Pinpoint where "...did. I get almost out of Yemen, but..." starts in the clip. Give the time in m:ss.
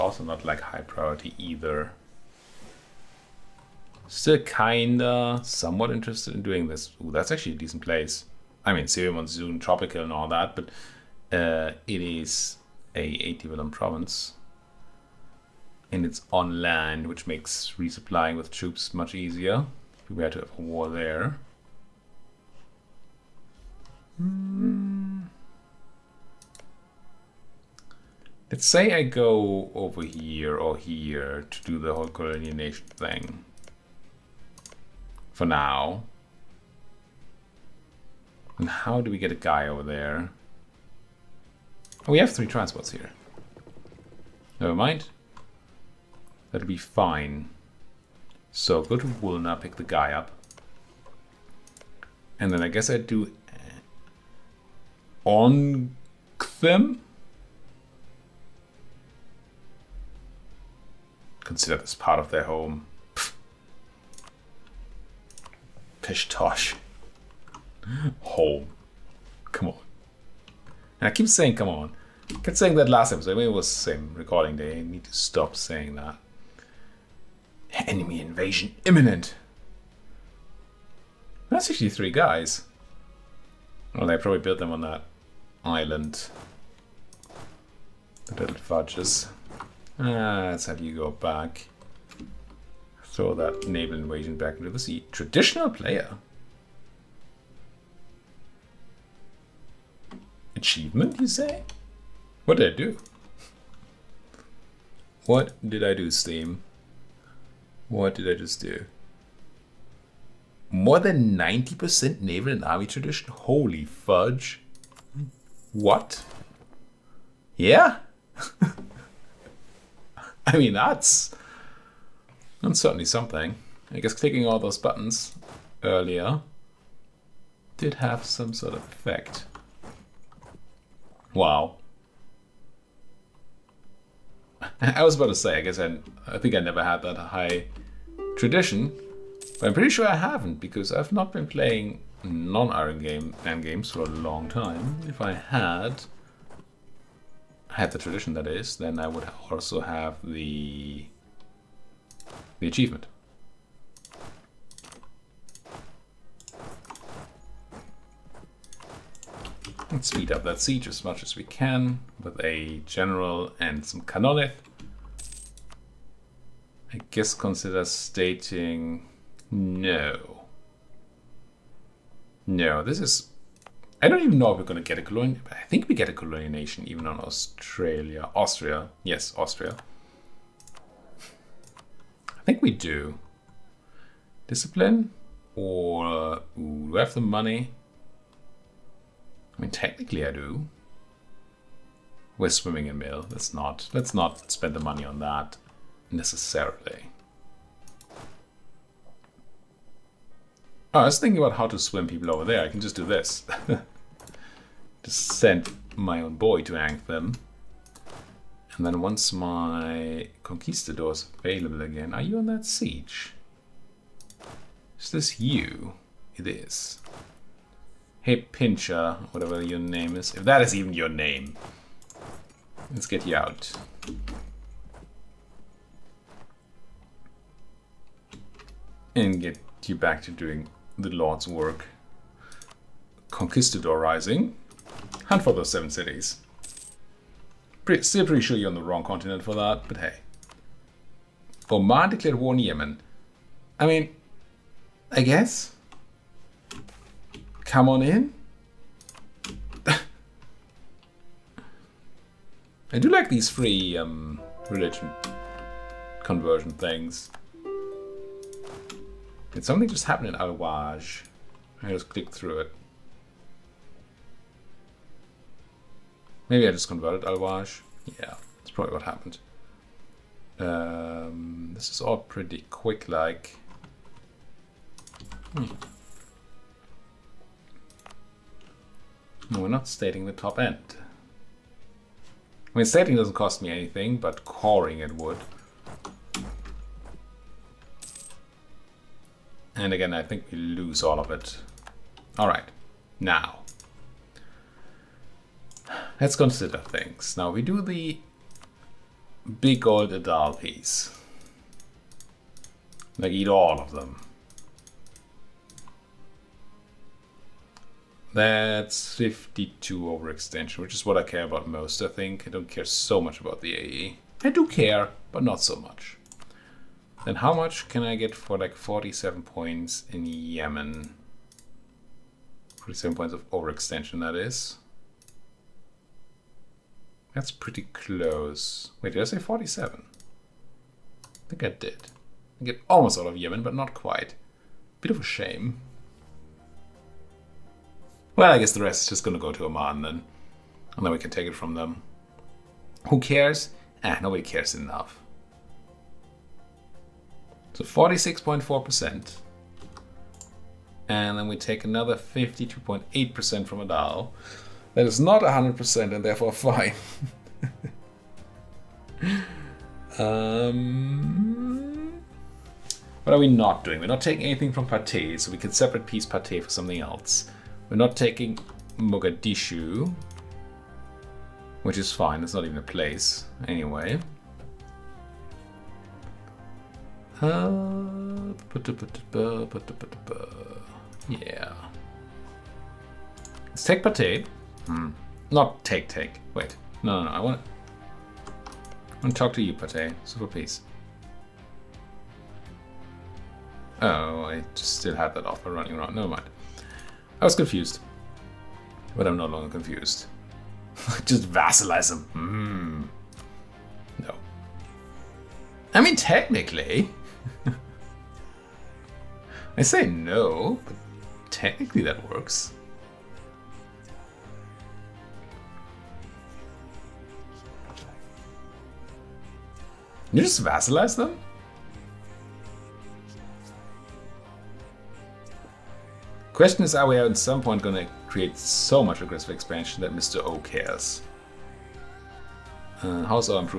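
5:31.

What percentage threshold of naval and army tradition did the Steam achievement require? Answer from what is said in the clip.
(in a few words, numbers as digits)
90%.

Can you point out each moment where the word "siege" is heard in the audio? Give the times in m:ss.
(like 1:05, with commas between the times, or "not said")
2:40, 3:32.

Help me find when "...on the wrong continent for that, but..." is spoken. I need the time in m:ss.
3:58.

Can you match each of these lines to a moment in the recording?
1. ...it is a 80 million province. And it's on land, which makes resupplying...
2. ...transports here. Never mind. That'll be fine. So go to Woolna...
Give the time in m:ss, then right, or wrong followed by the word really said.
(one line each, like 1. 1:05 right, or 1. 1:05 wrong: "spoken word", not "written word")
1. 0:11 right
2. 0:42 right.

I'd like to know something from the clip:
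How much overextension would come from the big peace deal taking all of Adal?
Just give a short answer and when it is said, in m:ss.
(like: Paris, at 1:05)
52, at 5:09.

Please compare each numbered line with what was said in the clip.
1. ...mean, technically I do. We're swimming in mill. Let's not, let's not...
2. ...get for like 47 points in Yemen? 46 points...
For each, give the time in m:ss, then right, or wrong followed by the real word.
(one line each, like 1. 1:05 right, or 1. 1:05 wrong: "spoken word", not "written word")
1. 3:09 right
2. 5:18 wrong: "47", not "46".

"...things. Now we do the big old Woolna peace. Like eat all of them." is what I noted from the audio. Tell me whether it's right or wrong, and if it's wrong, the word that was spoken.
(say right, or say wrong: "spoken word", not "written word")
wrong: "Adal", not "Woolna".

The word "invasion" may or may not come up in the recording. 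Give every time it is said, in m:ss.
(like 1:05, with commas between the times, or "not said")
1:18, 1:33.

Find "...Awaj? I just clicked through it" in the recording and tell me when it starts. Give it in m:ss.
4:20.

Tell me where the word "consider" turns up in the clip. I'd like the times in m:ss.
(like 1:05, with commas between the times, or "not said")
1:01, 2:47, 4:56.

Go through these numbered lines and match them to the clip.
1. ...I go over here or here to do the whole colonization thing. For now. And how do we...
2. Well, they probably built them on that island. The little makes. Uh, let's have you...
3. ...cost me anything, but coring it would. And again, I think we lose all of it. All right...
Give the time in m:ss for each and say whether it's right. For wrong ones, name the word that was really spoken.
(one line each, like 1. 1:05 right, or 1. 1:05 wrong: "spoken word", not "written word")
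1. 0:28 right
2. 1:23 wrong: "fudges", not "makes"
3. 4:43 right.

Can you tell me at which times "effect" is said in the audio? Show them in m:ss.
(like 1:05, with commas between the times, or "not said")
2:08.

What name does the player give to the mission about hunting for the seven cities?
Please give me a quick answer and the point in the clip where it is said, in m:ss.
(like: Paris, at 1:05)
Conquistador Rising, at 3:53.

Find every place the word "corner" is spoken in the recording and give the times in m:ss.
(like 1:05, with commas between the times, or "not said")
not said.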